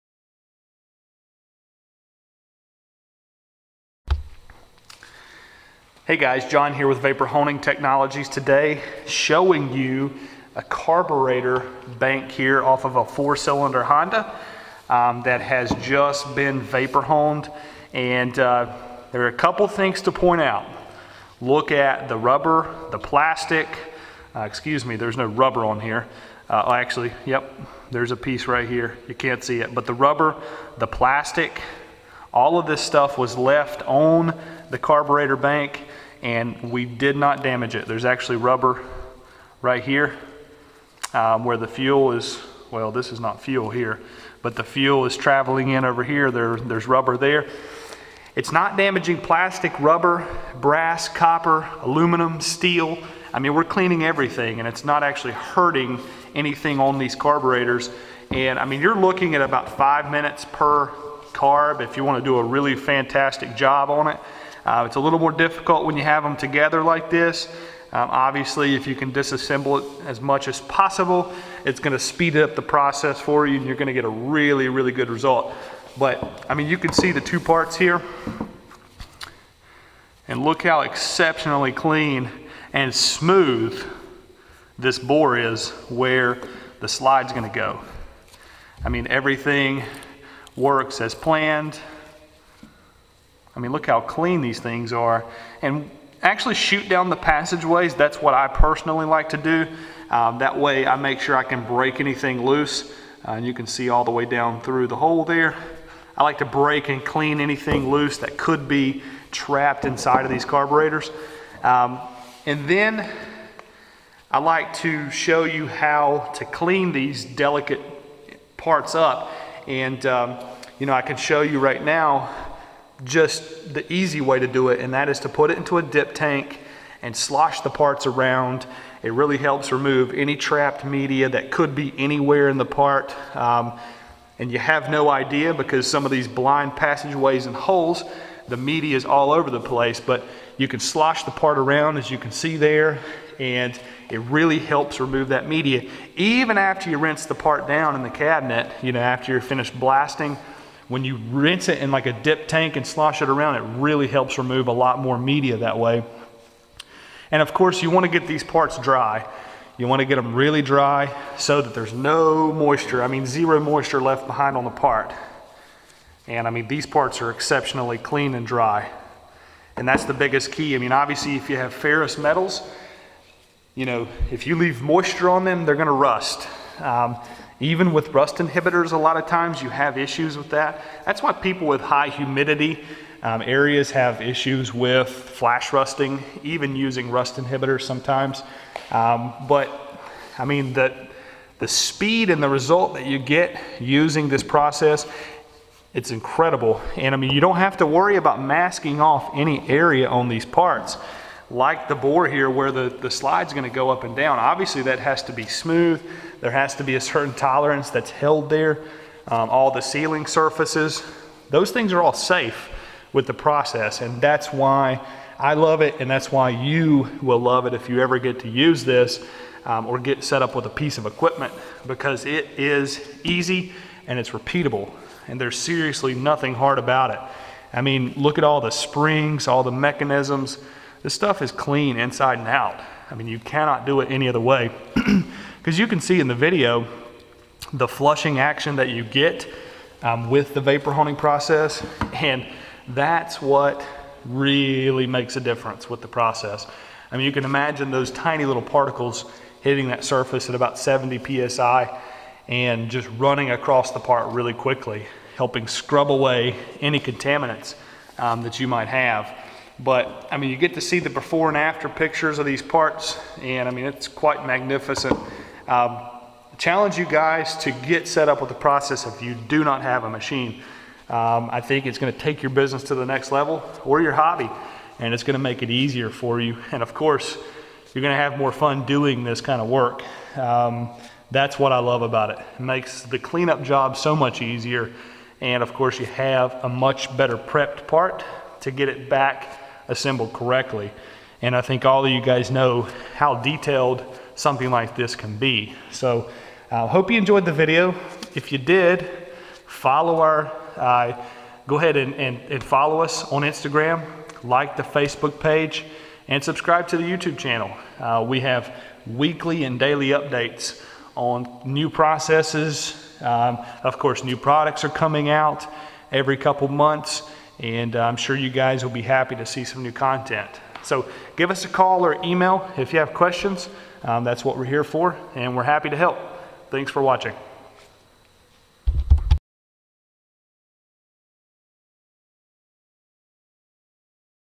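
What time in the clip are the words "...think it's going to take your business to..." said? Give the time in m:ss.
4:31.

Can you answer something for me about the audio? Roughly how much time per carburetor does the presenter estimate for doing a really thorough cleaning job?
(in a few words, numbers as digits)
5 minutes.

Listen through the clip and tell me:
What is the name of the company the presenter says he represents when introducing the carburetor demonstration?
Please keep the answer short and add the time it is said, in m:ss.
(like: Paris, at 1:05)
Vapor Honing Technologies, at 0:06.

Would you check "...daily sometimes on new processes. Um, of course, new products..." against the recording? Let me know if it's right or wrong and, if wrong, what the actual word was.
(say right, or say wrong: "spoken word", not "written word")
wrong: "updates", not "sometimes".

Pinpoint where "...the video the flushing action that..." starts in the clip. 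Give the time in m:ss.
3:56.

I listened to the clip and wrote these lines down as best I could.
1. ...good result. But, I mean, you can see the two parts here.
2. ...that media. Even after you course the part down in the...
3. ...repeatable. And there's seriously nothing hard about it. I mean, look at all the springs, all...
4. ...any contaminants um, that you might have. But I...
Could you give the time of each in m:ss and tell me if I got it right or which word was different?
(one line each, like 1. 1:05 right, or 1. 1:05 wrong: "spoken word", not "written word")
1. 1:14 right
2. 2:25 wrong: "rinse", not "course"
3. 3:44 right
4. 4:16 right.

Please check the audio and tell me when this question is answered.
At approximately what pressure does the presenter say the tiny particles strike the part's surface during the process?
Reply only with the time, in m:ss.
4:10.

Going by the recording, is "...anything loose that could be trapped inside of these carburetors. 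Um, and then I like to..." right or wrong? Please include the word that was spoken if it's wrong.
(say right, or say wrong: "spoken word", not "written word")
right.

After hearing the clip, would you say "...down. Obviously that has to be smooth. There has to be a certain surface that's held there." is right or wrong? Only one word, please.
wrong.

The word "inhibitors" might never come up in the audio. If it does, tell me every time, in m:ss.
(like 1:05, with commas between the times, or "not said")
2:58, 3:07.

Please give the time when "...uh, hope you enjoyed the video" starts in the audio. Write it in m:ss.
4:56.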